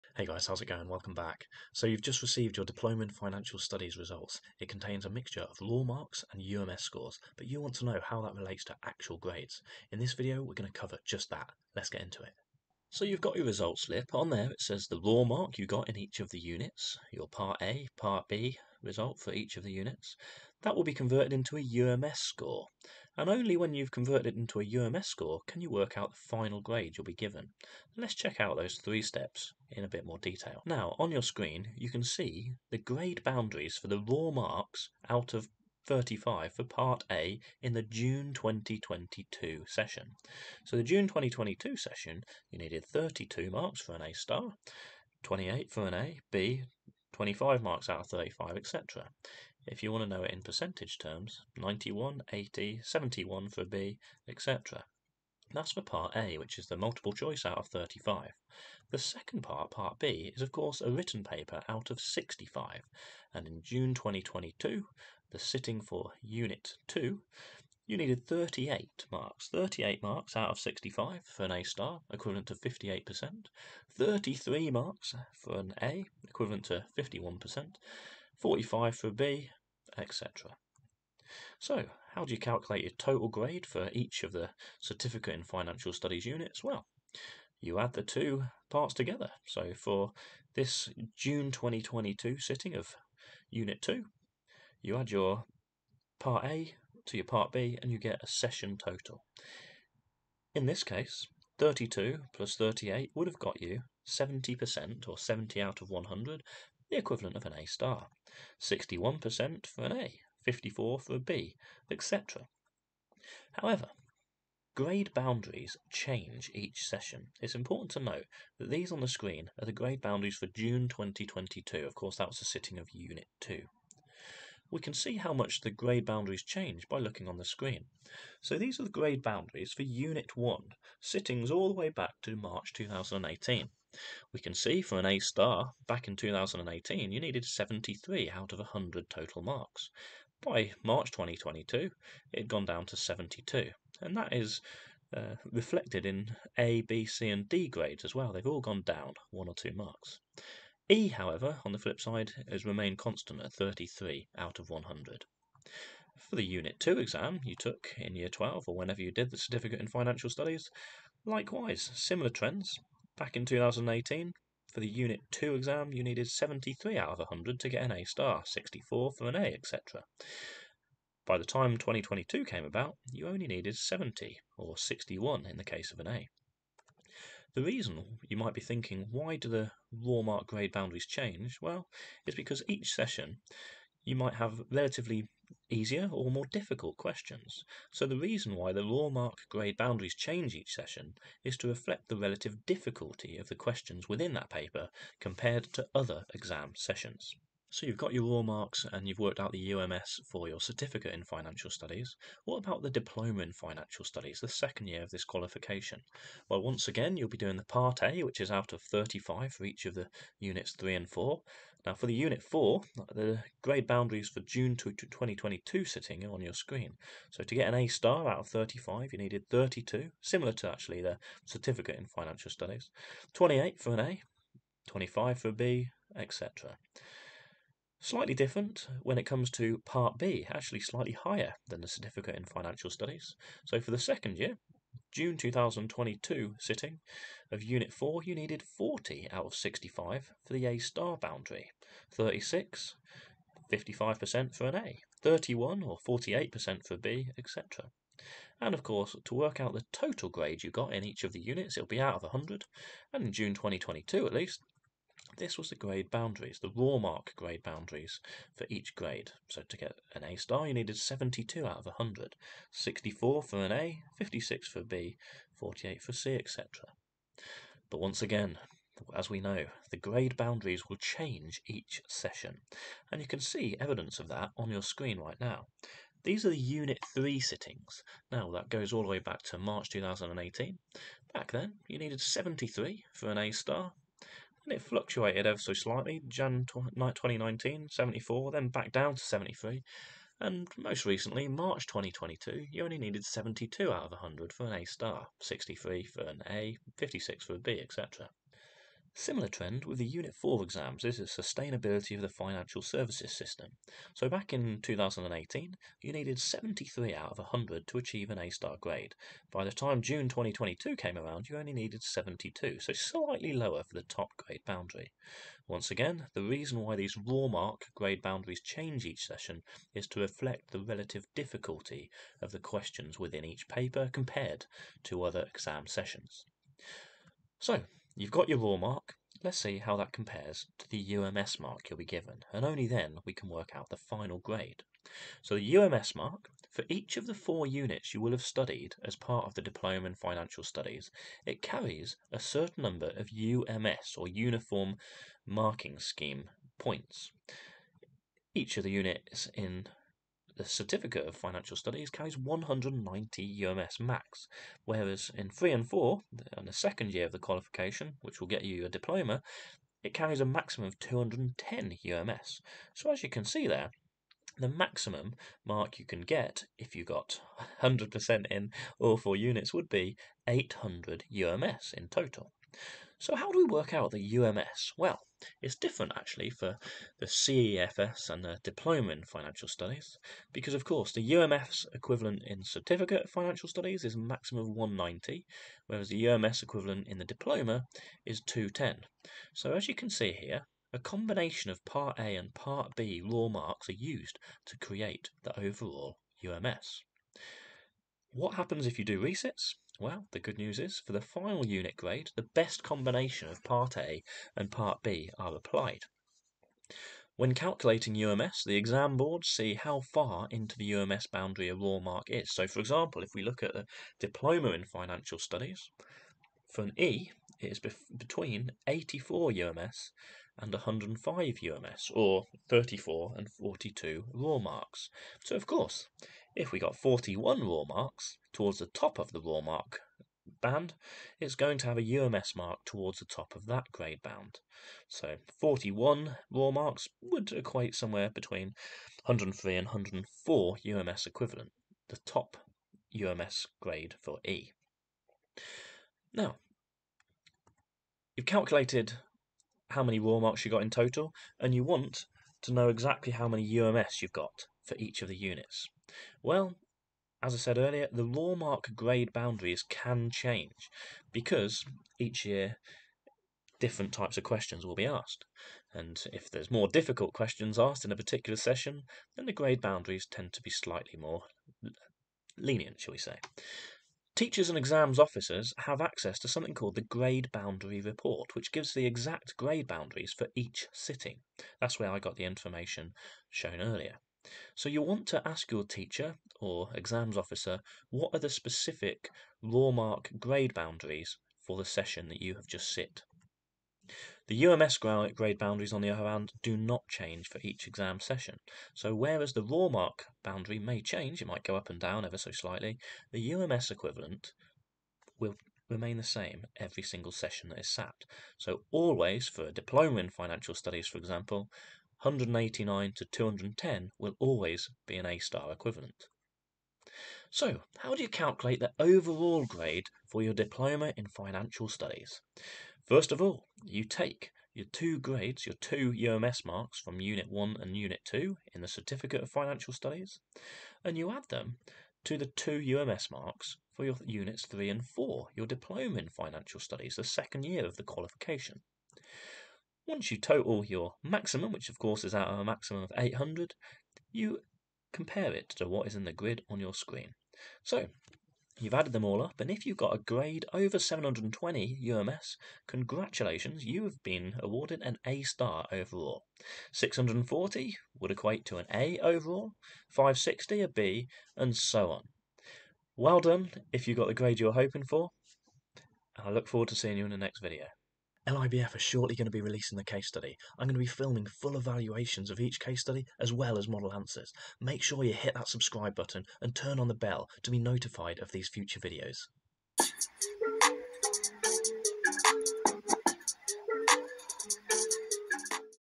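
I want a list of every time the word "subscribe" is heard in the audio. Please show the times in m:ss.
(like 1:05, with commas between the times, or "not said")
9:35.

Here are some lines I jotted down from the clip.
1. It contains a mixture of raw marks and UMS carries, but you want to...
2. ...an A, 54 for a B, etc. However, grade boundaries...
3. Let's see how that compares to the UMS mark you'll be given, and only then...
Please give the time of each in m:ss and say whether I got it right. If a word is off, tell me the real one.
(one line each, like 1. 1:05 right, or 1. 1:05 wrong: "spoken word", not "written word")
1. 0:04 wrong: "scores", not "carries"
2. 1:49 right
3. 5:29 right.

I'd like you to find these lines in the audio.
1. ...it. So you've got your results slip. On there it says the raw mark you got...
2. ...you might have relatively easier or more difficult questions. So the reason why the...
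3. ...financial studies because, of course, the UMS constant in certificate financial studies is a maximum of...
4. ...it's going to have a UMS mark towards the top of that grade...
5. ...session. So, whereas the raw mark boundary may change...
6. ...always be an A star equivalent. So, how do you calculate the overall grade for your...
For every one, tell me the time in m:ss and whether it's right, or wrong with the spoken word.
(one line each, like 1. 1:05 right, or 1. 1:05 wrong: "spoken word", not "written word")
1. 0:12 right
2. 3:04 right
3. 6:19 wrong: "equivalent", not "constant"
4. 7:11 right
5. 8:18 right
6. 8:34 right.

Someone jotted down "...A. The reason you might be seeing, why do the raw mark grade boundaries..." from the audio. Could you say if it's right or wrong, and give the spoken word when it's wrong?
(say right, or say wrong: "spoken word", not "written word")
wrong: "thinking", not "seeing".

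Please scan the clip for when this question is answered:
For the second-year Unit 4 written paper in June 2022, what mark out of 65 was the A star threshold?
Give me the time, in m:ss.
3:58.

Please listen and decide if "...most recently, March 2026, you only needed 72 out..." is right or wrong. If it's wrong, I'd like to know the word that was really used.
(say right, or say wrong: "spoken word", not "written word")
wrong: "2022", not "2026".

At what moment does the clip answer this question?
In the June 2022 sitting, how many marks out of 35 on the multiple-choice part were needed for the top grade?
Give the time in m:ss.
0:42.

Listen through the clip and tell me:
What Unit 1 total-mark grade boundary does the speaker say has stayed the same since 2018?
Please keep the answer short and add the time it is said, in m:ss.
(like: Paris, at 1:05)
33 out of 100, at 2:33.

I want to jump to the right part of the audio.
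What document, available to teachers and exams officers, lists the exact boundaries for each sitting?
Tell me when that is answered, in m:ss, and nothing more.
7:57.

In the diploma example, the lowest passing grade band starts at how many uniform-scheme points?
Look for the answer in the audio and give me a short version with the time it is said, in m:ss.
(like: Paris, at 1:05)
84, at 6:58.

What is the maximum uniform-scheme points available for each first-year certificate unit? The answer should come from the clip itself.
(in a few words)
190.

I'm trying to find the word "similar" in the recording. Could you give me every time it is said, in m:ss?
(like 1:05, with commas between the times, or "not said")
2:41, 3:40, 4:59.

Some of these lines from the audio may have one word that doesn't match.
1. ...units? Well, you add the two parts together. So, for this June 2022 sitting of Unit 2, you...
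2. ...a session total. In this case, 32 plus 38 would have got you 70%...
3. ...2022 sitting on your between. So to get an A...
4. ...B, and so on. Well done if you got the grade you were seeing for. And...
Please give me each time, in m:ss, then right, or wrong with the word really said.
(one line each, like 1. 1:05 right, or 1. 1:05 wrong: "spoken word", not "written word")
1. 1:26 right
2. 1:38 right
3. 3:34 wrong: "screen", not "between"
4. 9:20 wrong: "hoping", not "seeing".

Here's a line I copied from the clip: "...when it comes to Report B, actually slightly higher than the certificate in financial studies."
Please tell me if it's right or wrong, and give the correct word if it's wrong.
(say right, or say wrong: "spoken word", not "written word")
wrong: "Part", not "Report".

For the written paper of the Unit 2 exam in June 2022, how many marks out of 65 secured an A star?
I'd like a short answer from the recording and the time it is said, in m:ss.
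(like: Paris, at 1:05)
38, at 1:09.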